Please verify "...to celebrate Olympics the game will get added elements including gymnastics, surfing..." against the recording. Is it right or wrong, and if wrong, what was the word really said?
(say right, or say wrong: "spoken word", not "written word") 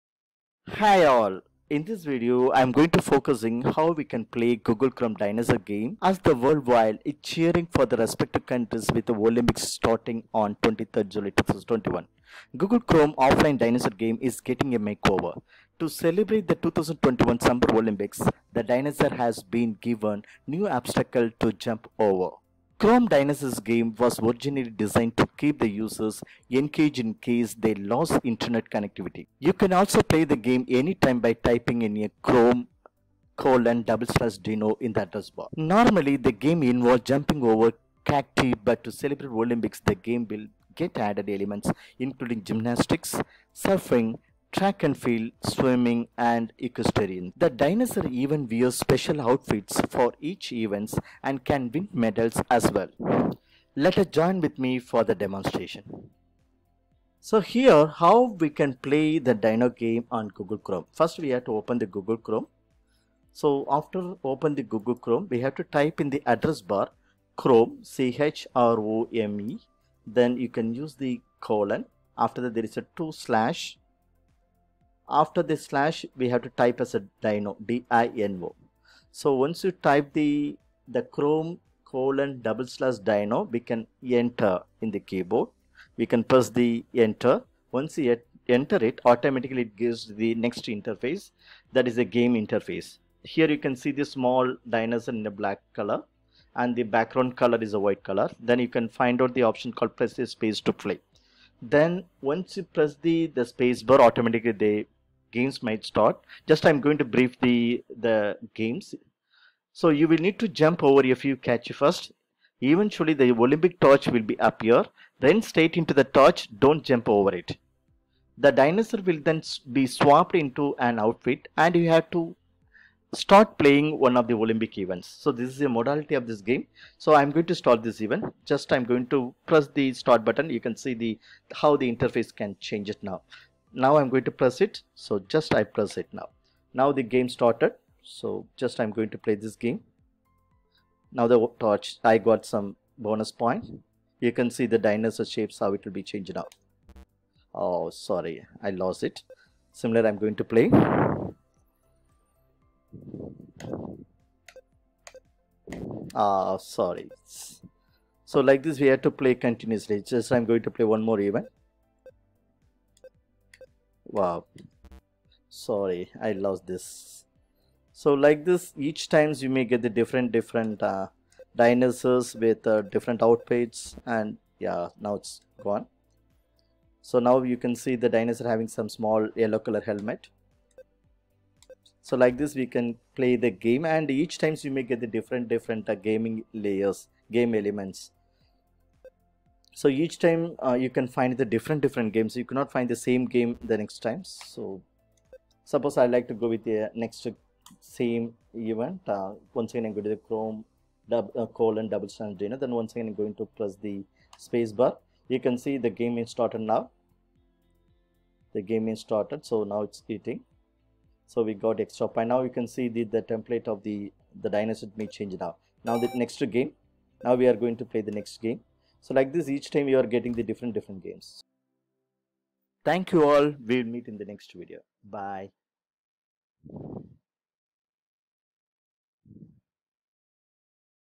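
right.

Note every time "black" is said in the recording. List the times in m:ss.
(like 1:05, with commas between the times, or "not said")
1:35.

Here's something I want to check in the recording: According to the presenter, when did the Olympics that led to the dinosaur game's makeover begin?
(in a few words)
23rd July 2021.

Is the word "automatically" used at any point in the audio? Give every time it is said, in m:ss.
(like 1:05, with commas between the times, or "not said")
1:29, 1:44.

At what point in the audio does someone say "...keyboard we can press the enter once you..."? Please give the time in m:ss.
1:25.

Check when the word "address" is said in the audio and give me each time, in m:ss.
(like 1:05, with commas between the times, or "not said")
0:35, 1:06.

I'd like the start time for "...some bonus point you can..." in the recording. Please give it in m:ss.
2:22.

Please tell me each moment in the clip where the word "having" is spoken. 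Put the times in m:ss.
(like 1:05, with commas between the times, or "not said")
2:58.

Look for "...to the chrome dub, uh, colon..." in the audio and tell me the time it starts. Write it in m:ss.
3:20.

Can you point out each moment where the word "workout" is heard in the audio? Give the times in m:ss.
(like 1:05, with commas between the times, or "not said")
not said.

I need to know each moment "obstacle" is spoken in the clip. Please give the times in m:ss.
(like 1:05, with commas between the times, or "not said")
0:20.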